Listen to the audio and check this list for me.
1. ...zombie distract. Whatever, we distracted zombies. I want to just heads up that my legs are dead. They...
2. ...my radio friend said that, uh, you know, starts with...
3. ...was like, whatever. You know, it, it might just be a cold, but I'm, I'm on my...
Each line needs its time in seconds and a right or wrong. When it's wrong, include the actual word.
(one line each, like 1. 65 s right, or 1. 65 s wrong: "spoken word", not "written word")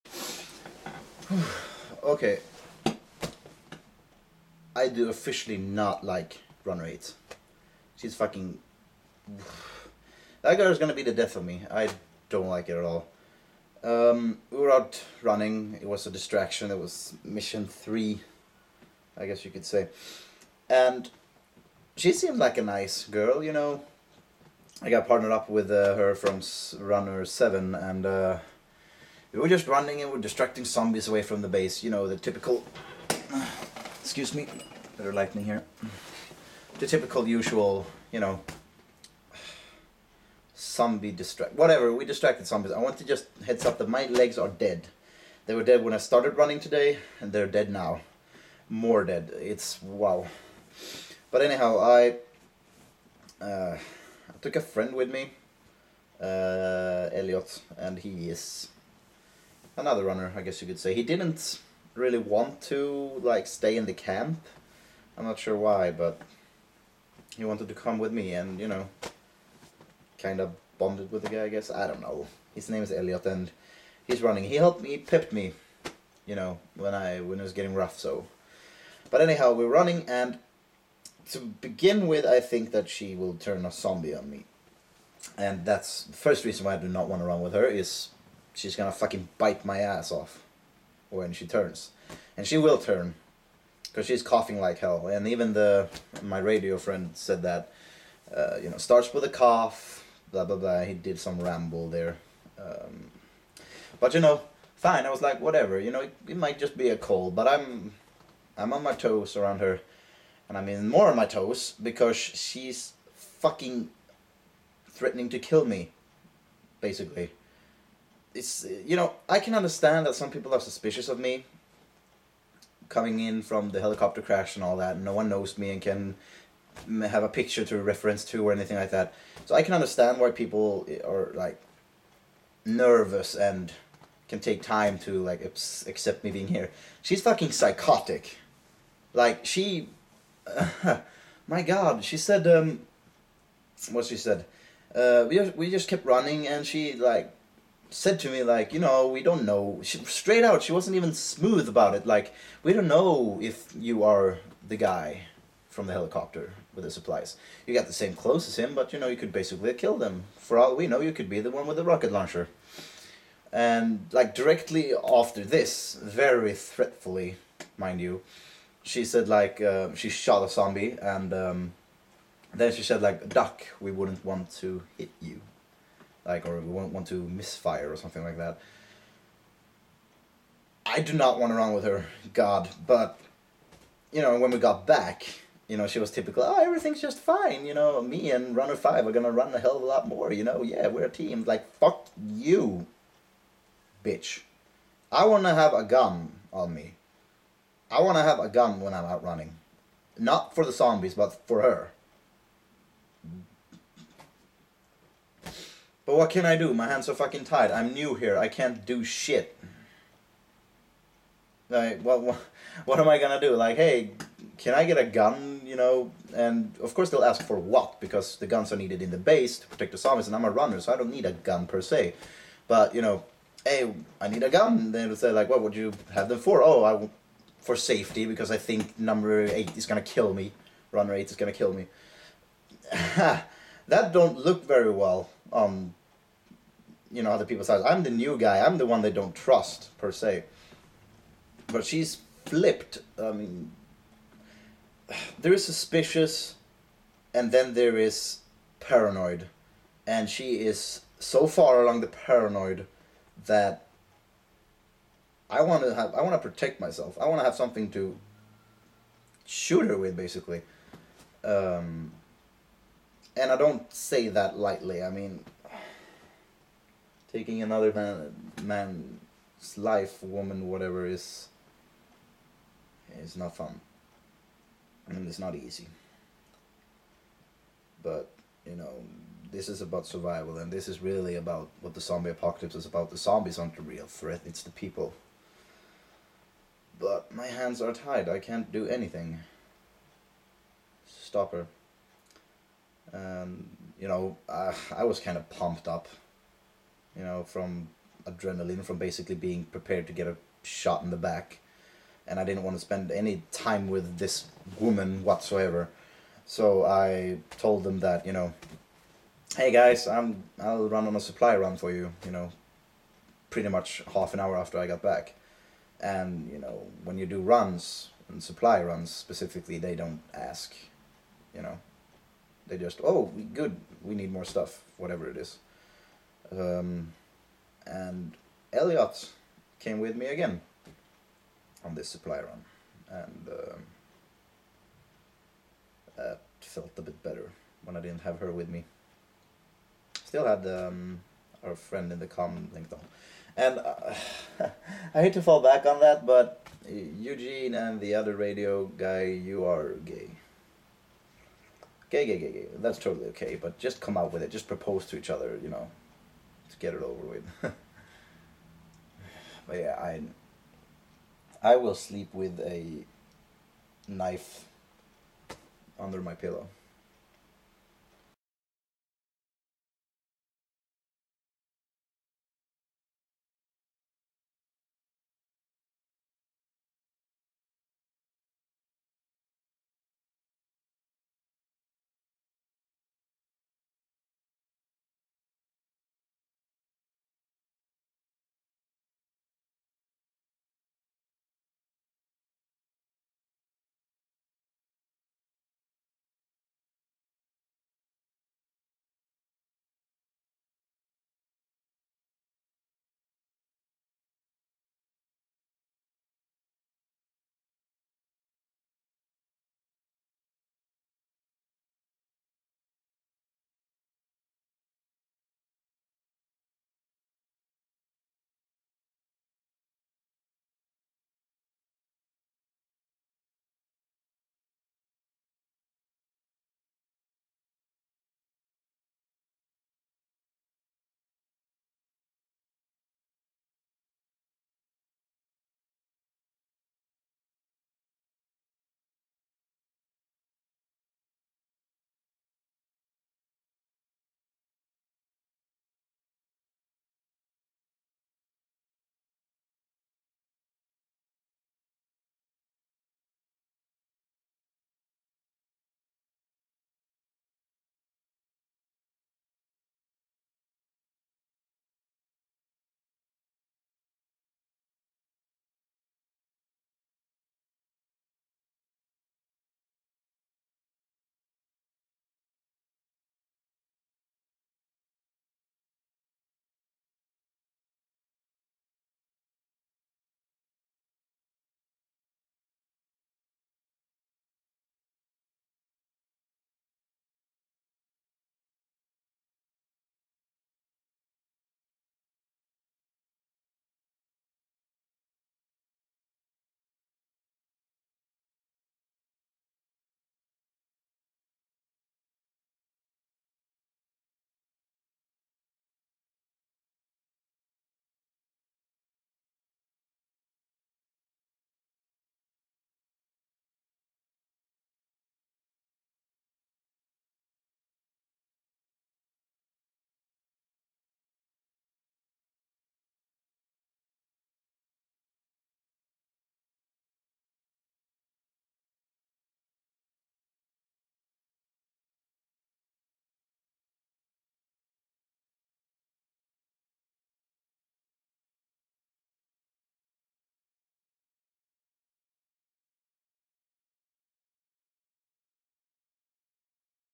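1. 40 s right
2. 96 s right
3. 105 s right.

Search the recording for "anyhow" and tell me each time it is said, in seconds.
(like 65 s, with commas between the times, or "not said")
51 s, 79 s.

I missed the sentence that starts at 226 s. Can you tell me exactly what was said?
Oh, I for safety because I think number eight is gonna kill me.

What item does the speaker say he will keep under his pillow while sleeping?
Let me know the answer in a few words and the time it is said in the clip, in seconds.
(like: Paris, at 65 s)
knife, at 364 s.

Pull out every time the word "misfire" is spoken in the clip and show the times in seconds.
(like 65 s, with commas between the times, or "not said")
177 s.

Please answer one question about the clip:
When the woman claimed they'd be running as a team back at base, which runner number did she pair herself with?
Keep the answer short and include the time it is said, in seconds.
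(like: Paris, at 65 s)
Runner 5, at 188 s.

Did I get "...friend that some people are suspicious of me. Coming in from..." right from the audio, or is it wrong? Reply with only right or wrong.
wrong.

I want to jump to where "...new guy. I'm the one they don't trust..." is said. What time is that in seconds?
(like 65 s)
238 s.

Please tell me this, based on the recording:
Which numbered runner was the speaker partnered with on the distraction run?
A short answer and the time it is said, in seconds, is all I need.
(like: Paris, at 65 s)
Runner 7, at 26 s.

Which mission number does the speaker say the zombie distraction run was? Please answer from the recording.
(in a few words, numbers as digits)
three.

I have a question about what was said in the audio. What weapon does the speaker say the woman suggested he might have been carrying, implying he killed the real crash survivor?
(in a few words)
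rocket launcher.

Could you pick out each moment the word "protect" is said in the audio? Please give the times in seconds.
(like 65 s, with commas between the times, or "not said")
219 s, 256 s.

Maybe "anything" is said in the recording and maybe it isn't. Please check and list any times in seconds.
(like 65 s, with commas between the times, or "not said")
128 s, 288 s.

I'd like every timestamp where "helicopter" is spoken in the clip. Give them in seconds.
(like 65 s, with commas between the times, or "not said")
123 s, 155 s.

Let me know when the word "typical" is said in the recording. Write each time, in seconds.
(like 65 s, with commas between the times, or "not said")
32 s, 36 s, 186 s.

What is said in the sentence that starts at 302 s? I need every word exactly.
And I didn't want to spend any time with this woman whatsoever.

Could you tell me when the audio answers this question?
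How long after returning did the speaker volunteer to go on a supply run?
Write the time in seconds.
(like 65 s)
314 s.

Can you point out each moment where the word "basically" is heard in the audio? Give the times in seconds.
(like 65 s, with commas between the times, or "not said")
116 s, 159 s, 260 s, 298 s.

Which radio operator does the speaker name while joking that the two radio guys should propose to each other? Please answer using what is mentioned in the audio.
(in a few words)
Eugene.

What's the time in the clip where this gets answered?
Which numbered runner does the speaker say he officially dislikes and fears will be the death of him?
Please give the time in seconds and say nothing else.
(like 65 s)
6 s.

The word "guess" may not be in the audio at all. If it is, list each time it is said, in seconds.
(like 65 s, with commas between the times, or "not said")
19 s, 60 s, 71 s.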